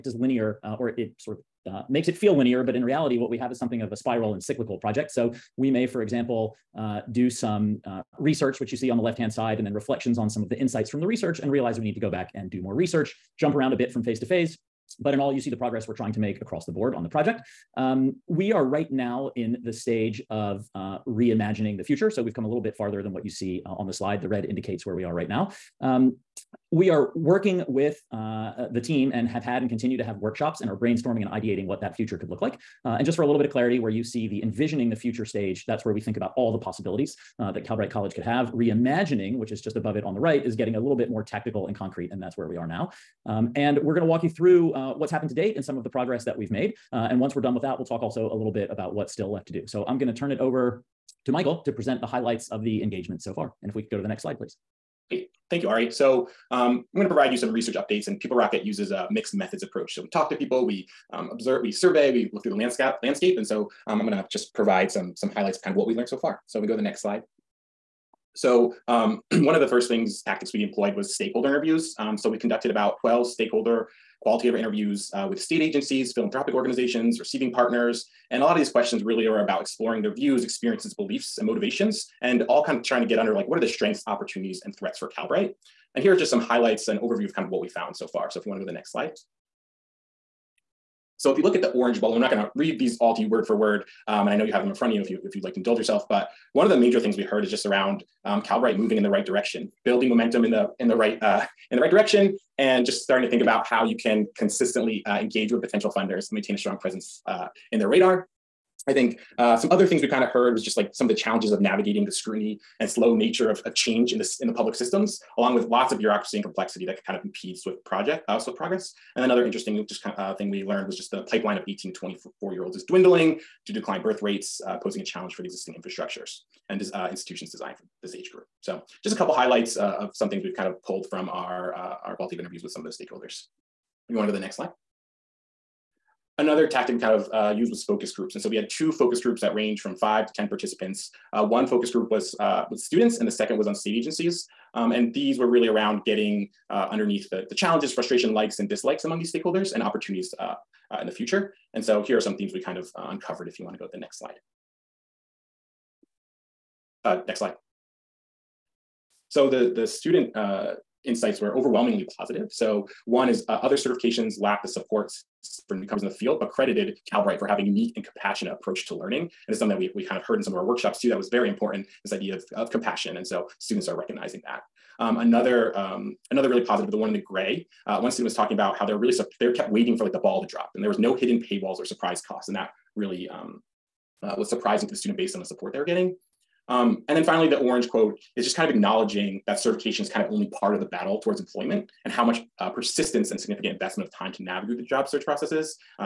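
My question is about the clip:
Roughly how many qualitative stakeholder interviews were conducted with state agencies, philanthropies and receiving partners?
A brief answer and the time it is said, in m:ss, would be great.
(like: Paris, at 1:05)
12, at 1:13.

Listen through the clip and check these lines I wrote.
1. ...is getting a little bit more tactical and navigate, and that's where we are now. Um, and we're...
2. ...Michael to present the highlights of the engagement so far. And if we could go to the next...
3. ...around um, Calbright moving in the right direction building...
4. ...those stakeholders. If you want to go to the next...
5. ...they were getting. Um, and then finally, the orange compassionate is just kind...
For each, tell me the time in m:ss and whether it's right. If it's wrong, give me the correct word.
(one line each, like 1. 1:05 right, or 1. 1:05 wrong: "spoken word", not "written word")
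1. 0:40 wrong: "concrete", not "navigate"
2. 0:51 right
3. 1:37 right
4. 2:12 right
5. 3:05 wrong: "quote", not "compassionate".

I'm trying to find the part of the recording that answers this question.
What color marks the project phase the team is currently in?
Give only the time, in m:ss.
0:24.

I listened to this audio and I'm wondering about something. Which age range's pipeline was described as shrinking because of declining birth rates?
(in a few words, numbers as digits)
18 to 24.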